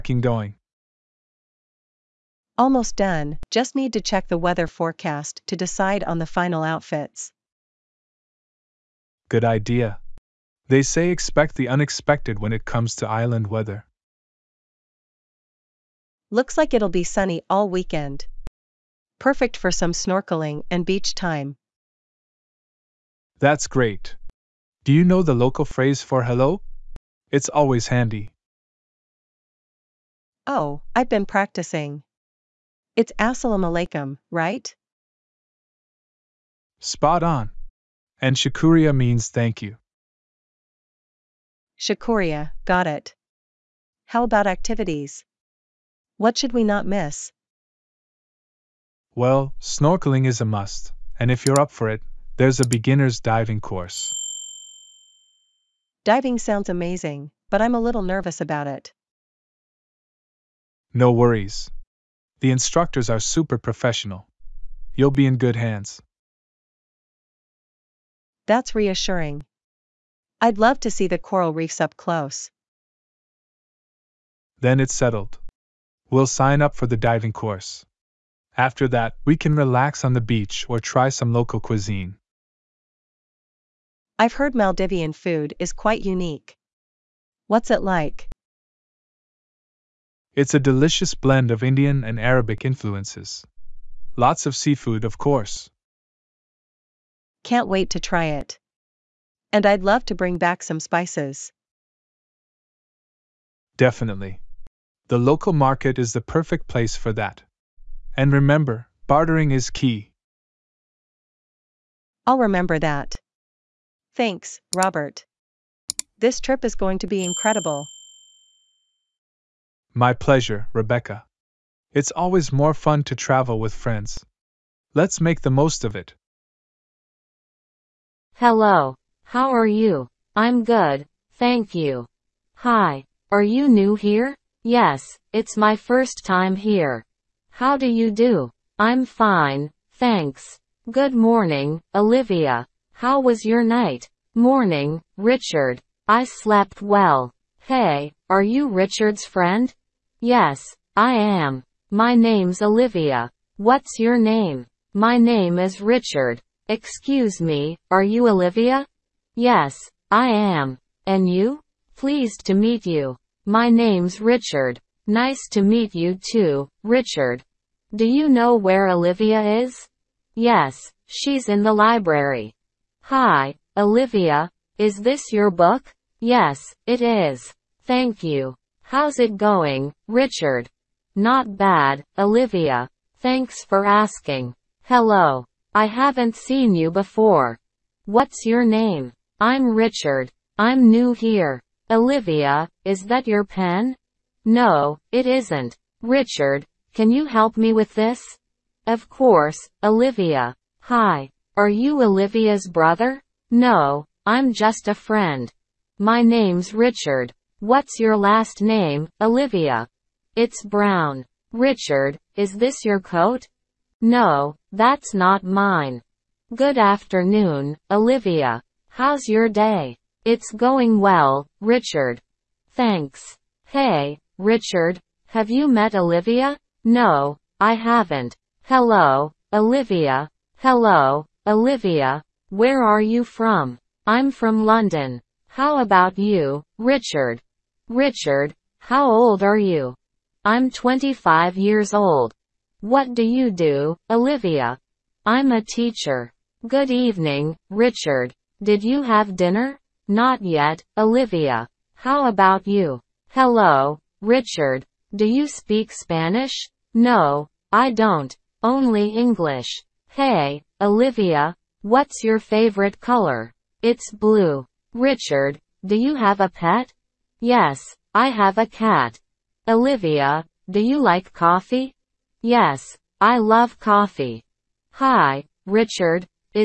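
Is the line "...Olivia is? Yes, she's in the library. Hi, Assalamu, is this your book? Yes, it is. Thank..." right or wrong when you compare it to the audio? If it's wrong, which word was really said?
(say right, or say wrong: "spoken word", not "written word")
wrong: "Olivia", not "Assalamu".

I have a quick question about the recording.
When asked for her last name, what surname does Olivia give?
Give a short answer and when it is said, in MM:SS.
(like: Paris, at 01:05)
Brown, at 03:30.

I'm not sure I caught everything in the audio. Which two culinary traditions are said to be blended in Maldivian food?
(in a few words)
Indian and Arabic.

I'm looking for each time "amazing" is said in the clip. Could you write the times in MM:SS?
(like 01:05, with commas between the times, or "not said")
00:56.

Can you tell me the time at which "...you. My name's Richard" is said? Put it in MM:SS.
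02:42.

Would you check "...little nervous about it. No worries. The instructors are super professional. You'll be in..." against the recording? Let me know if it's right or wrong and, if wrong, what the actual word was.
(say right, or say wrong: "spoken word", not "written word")
right.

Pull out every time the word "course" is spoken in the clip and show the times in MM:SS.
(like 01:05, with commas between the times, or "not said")
00:53, 01:17, 01:35, 03:19.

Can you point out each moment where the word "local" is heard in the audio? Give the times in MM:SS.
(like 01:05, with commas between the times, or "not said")
00:25, 01:21, 01:45.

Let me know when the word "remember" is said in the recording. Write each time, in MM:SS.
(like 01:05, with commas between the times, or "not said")
01:48, 01:52.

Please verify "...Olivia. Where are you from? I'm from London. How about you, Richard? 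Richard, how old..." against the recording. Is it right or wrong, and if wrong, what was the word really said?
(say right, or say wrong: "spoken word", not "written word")
right.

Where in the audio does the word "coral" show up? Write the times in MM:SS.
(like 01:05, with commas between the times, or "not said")
01:11.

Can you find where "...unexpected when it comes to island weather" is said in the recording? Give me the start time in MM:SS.
00:11.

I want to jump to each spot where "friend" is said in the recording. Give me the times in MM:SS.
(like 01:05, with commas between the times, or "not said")
02:03, 02:29, 03:24.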